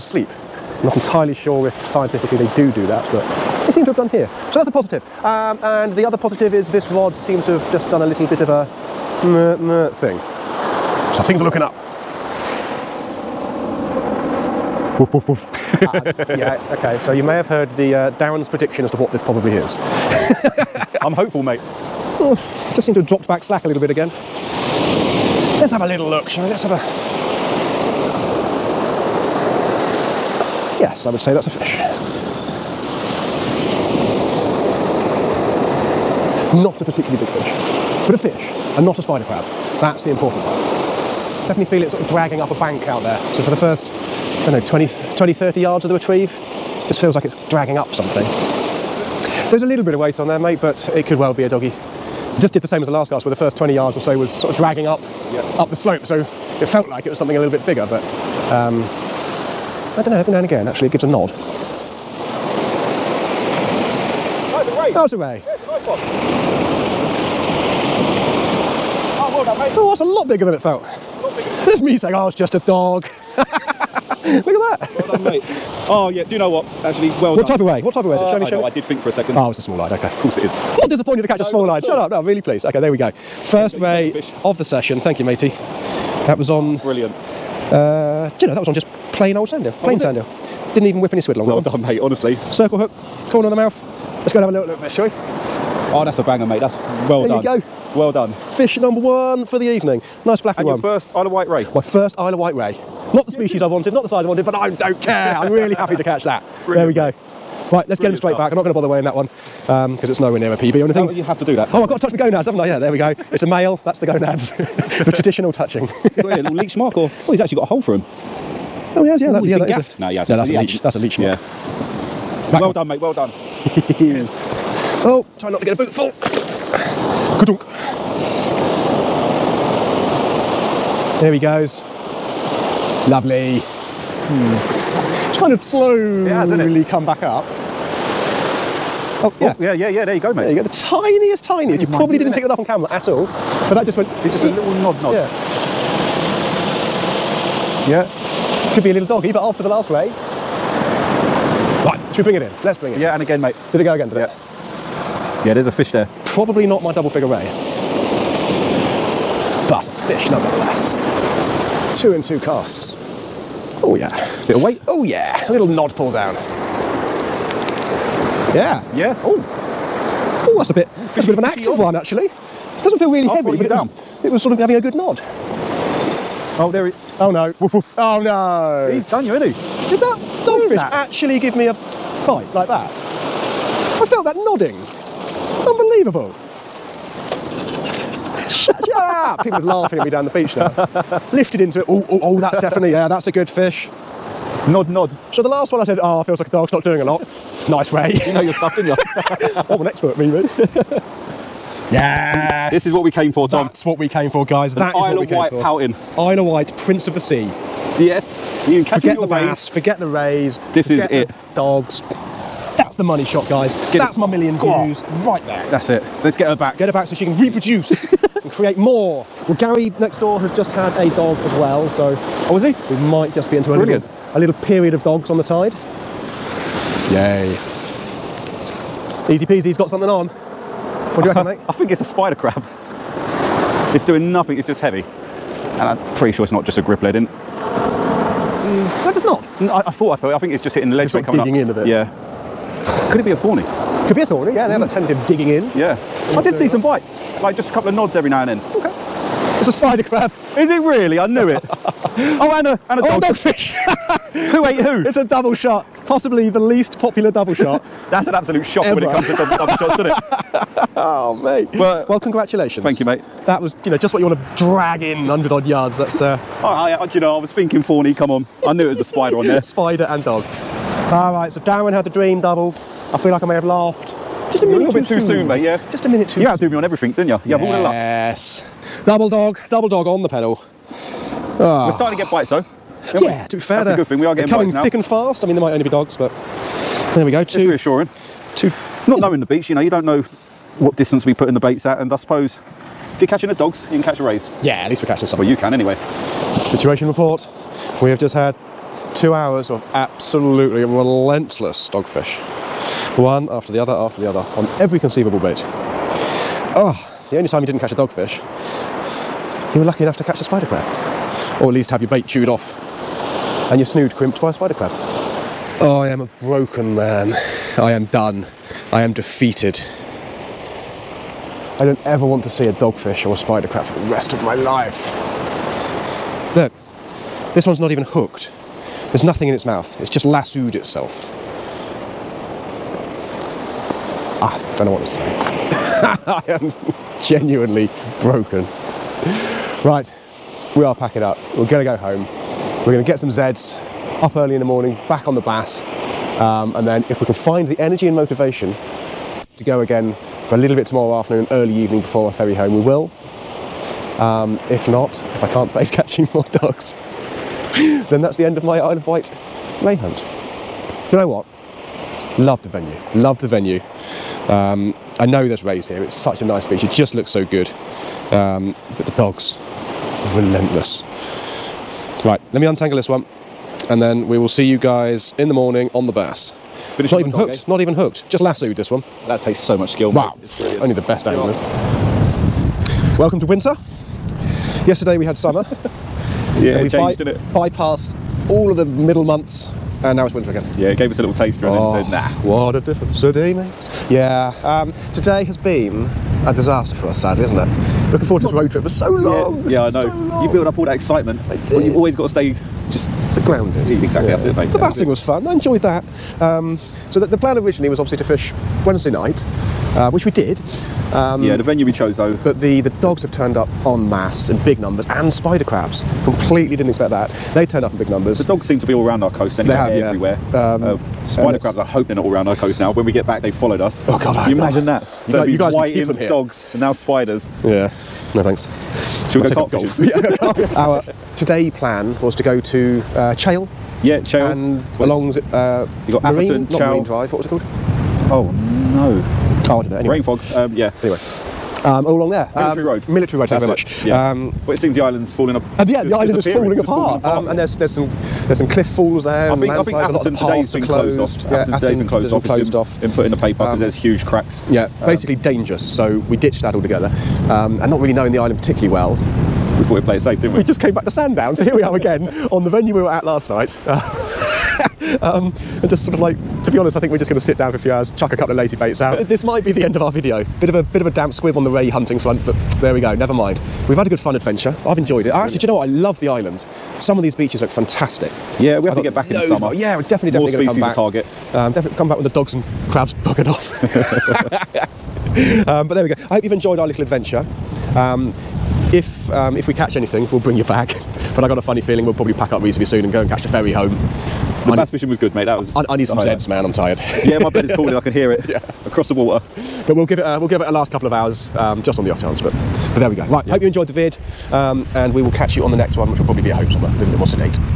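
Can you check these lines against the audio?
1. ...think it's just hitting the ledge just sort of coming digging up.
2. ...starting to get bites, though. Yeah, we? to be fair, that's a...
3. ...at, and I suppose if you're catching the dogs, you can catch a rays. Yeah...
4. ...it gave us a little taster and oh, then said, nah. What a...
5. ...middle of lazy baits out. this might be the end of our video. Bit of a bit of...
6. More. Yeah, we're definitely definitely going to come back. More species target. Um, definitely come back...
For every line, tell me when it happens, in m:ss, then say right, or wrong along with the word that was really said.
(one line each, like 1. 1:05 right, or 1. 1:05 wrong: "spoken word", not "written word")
1. 4:00 right
2. 4:41 right
3. 4:51 right
4. 6:30 right
5. 7:48 wrong: "couple", not "middle"
6. 7:59 right.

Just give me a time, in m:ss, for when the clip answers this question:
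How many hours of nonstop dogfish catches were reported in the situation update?
4:59.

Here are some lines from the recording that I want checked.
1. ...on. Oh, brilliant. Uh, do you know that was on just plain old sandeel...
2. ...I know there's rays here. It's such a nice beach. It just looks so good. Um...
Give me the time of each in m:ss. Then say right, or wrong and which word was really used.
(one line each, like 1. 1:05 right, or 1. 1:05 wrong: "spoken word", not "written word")
1. 1:26 right
2. 6:05 right.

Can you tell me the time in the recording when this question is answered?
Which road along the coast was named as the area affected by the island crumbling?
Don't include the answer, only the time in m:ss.
7:23.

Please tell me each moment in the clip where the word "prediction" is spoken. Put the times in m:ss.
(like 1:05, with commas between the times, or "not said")
0:18.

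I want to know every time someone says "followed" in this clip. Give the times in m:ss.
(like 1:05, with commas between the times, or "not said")
7:03.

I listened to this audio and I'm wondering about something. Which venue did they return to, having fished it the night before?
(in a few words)
Sandown.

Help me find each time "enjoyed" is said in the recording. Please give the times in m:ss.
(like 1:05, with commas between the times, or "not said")
6:45, 7:54, 8:06, 8:23.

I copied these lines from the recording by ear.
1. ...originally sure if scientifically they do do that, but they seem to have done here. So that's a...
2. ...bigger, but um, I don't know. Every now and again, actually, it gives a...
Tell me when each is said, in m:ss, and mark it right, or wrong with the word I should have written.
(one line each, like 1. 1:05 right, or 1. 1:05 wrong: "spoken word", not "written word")
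1. 0:00 wrong: "entirely", not "originally"
2. 0:57 right.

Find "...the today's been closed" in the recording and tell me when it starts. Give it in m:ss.
7:30.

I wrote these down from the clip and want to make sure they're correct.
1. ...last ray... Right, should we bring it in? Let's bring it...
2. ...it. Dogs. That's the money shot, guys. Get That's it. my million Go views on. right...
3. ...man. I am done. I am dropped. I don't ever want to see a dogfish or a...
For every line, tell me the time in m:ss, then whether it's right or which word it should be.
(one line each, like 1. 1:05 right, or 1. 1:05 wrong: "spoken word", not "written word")
1. 2:29 right
2. 3:31 right
3. 5:16 wrong: "defeated", not "dropped".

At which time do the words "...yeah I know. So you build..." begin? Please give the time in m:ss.
6:39.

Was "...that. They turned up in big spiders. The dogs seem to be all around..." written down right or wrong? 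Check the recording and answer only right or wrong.
wrong.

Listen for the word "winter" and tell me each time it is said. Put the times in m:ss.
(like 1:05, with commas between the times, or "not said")
6:23, 6:30.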